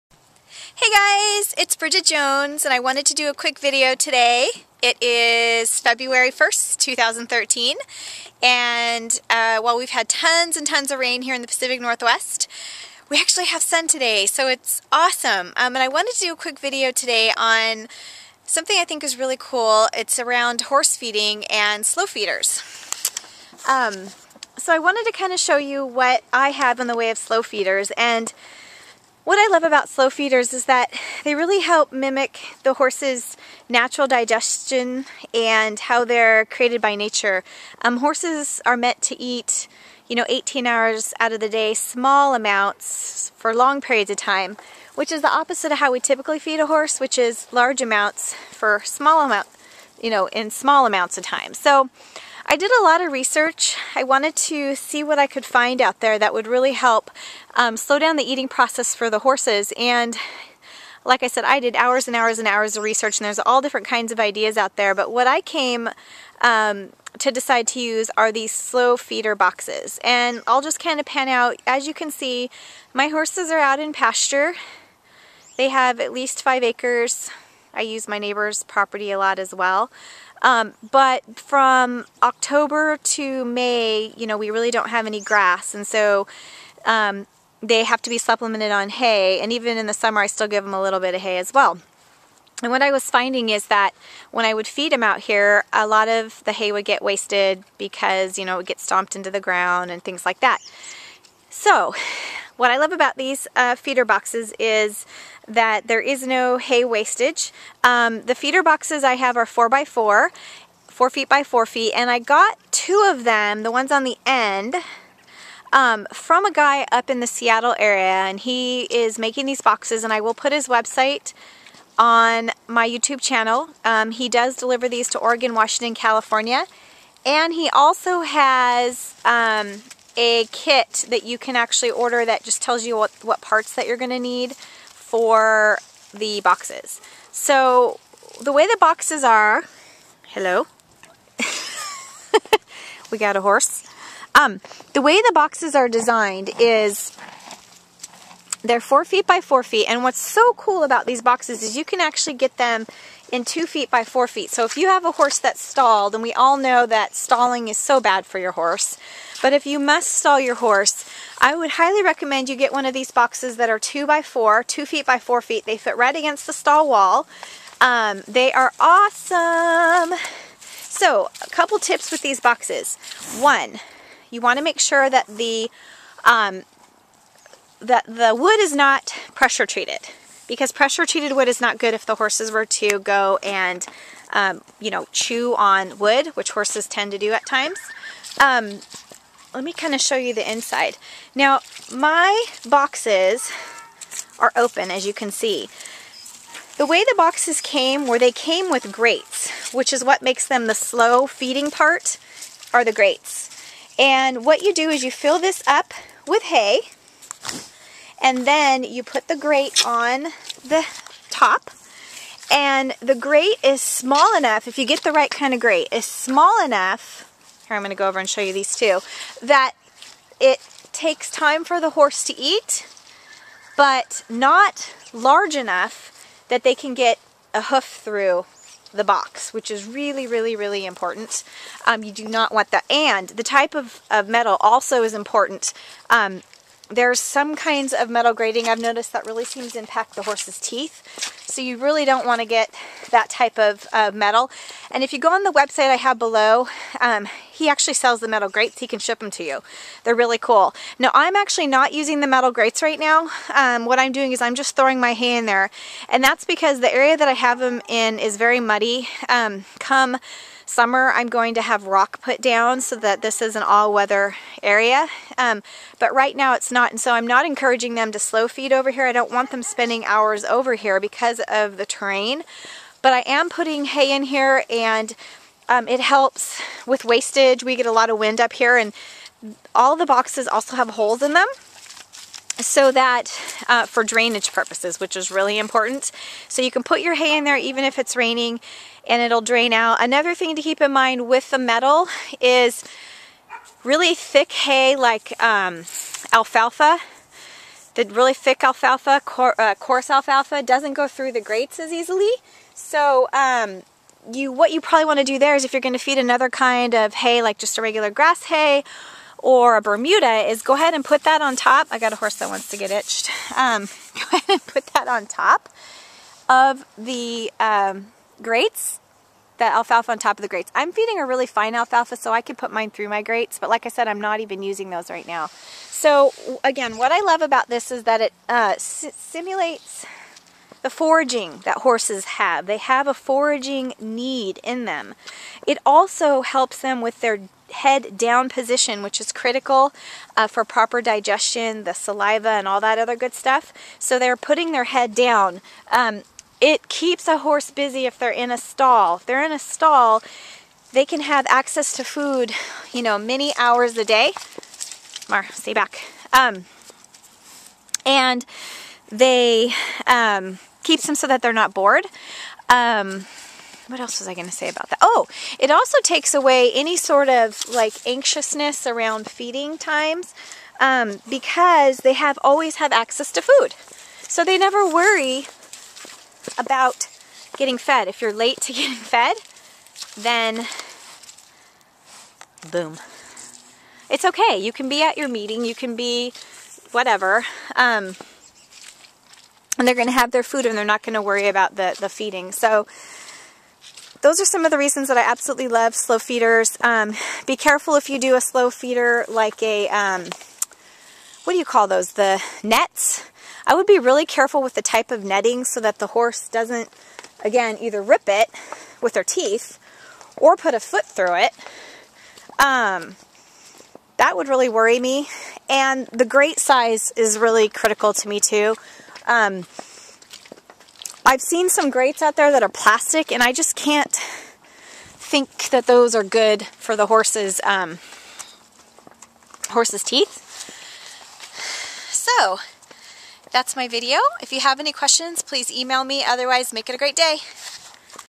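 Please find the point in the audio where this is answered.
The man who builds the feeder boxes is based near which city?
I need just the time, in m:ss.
1:57.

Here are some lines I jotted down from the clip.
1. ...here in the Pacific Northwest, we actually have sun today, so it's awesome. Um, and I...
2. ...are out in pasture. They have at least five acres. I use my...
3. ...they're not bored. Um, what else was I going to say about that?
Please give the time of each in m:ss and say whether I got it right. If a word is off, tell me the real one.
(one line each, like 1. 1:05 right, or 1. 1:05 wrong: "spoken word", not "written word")
1. 0:11 right
2. 1:13 right
3. 6:01 right.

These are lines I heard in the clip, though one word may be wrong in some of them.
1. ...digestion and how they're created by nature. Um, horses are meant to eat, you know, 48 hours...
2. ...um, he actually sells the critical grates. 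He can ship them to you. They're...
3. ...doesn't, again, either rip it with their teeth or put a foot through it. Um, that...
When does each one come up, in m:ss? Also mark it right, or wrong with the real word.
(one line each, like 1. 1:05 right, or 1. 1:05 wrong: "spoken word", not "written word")
1. 0:34 wrong: "18", not "48"
2. 4:06 wrong: "metal", not "critical"
3. 6:46 right.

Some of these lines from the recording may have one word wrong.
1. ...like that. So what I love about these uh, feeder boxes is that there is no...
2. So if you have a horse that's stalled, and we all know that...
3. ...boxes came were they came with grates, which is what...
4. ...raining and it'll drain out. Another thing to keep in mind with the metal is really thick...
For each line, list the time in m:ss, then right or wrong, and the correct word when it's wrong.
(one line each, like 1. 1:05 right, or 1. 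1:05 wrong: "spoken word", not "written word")
1. 1:40 right
2. 2:34 right
3. 3:17 right
4. 4:48 right.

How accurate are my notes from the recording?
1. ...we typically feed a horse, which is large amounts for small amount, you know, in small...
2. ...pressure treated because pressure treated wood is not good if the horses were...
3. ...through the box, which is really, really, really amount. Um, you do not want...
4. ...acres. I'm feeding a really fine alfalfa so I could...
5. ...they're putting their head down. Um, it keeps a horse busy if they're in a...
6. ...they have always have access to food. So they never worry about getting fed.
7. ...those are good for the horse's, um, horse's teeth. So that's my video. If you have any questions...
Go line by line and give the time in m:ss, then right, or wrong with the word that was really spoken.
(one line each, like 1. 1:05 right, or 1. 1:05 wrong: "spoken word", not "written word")
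1. 0:45 right
2. 2:59 right
3. 3:48 wrong: "important", not "amount"
4. 5:20 wrong: "grates", not "acres"
5. 5:44 right
6. 6:11 right
7. 7:05 right.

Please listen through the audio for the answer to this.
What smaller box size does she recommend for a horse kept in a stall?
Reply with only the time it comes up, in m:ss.
2:44.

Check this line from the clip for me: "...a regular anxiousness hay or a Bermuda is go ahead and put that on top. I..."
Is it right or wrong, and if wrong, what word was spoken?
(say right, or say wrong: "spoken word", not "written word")
wrong: "grass", not "anxiousness".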